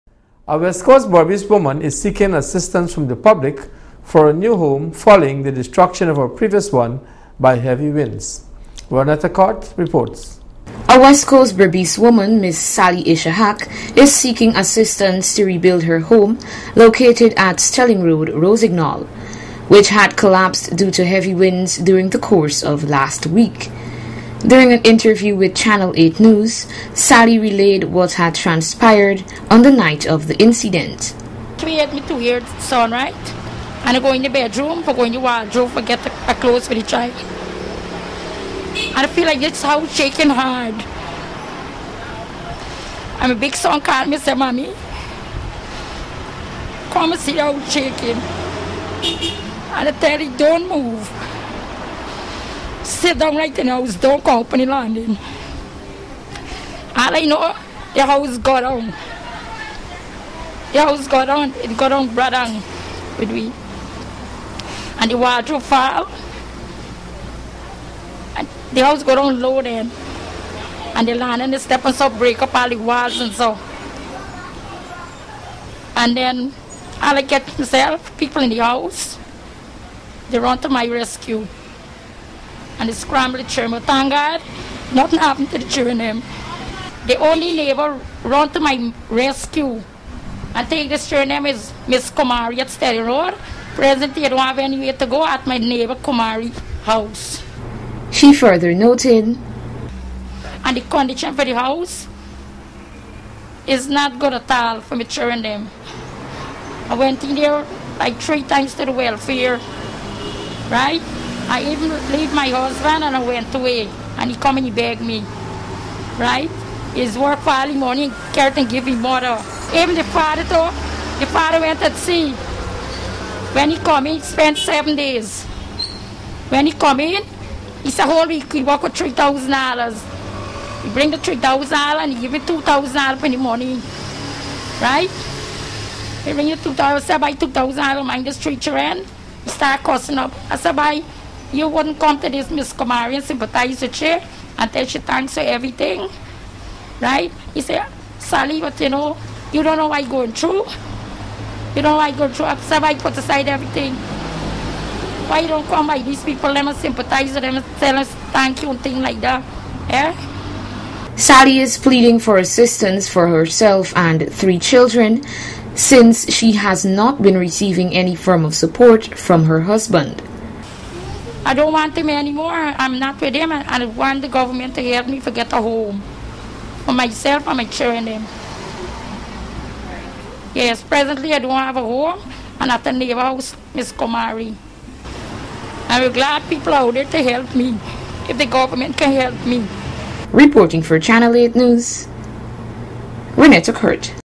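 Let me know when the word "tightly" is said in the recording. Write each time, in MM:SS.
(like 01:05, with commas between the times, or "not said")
not said.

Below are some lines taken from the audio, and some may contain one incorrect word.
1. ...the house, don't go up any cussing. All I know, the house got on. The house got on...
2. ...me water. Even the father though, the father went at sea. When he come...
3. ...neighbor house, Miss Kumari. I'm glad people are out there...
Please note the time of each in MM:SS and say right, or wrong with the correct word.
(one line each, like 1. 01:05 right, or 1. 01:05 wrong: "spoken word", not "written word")
1. 00:53 wrong: "landing", not "cussing"
2. 01:58 wrong: "mother", not "water"
3. 03:02 right.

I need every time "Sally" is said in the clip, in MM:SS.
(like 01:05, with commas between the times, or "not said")
00:12, 00:26, 02:28, 02:41.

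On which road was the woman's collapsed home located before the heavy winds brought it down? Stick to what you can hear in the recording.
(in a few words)
Stelling Road.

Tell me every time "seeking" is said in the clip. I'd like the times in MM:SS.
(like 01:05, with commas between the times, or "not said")
00:02, 00:14.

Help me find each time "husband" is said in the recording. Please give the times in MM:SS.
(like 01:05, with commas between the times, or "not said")
01:52, 02:49.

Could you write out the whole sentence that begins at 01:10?
And the land and the step and so break up all the walls and so.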